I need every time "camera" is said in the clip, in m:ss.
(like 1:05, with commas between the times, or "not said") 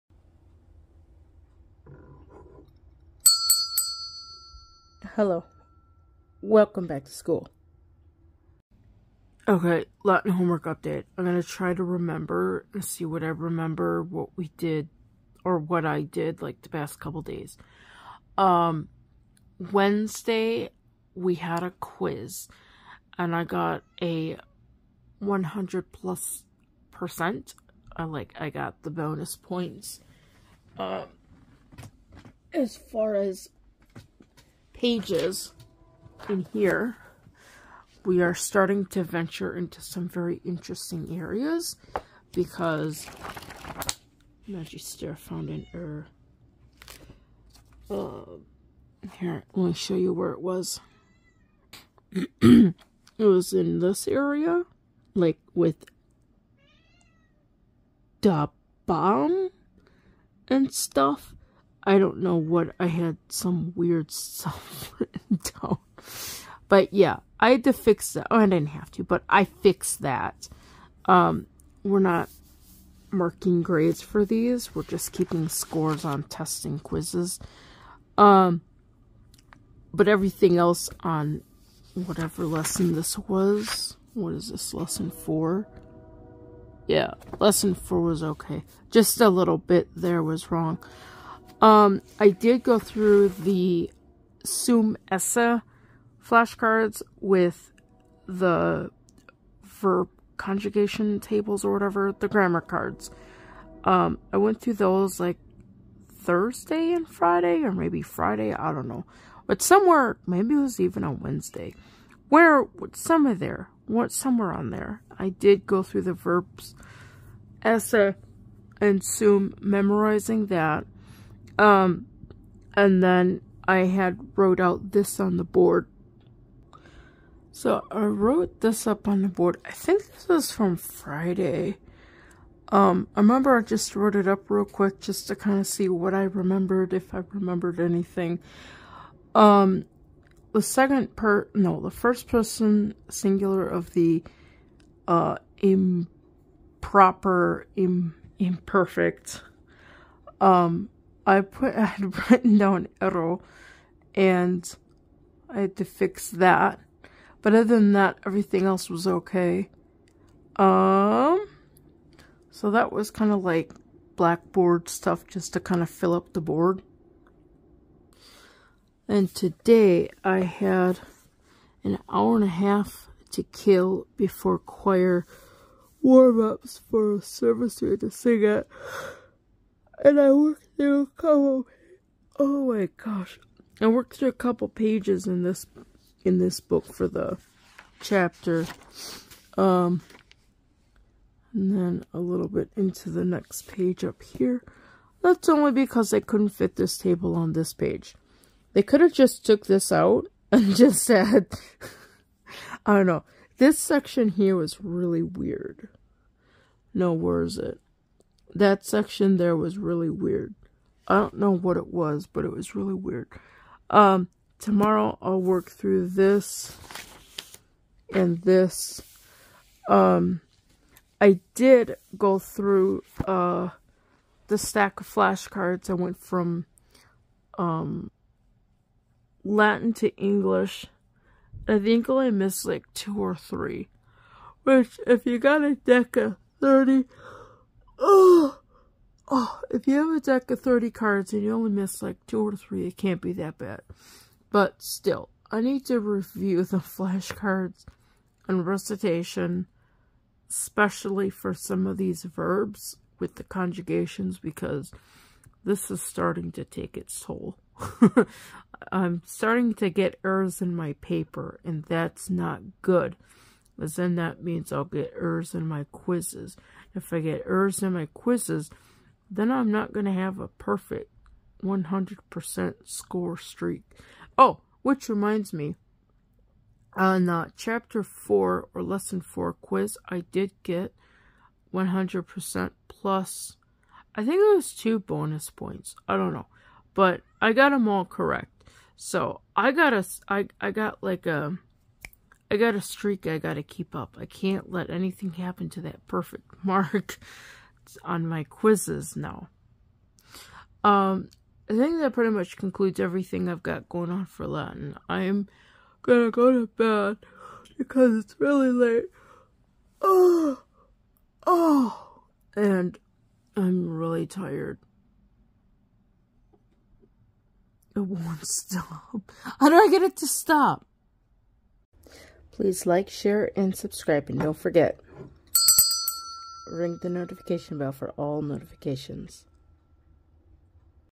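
not said.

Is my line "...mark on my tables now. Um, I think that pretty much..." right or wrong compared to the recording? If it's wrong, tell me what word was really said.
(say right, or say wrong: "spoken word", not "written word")
wrong: "quizzes", not "tables".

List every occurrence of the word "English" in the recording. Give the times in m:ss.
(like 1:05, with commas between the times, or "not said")
3:50.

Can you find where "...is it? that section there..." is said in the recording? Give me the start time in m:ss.
3:27.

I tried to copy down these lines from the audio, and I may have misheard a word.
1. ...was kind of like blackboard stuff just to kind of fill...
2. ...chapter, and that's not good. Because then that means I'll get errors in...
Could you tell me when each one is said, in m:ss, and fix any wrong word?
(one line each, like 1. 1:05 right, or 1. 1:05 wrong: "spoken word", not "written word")
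1. 2:42 right
2. 4:21 wrong: "paper", not "chapter".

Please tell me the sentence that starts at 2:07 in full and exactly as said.
So I wrote this up on the board.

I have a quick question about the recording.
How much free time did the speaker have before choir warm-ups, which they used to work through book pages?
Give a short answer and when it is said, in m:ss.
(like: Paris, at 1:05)
an hour and a half, at 2:51.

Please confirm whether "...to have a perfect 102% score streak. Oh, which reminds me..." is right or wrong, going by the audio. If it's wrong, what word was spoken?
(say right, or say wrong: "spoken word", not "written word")
wrong: "100", not "102".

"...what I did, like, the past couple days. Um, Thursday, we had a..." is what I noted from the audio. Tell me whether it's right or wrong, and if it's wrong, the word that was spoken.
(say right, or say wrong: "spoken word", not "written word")
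wrong: "Wednesday", not "Thursday".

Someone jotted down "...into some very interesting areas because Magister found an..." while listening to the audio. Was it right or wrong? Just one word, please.
right.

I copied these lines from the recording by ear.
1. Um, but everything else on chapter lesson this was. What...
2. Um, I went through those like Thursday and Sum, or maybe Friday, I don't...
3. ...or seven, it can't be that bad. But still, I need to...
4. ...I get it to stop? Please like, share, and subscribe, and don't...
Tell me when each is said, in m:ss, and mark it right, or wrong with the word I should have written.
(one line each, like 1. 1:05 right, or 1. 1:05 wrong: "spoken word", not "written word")
1. 1:18 wrong: "whatever", not "chapter"
2. 1:43 wrong: "Friday", not "Sum"
3. 4:02 wrong: "three", not "seven"
4. 5:19 right.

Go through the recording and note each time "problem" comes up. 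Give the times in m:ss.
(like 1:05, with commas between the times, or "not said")
not said.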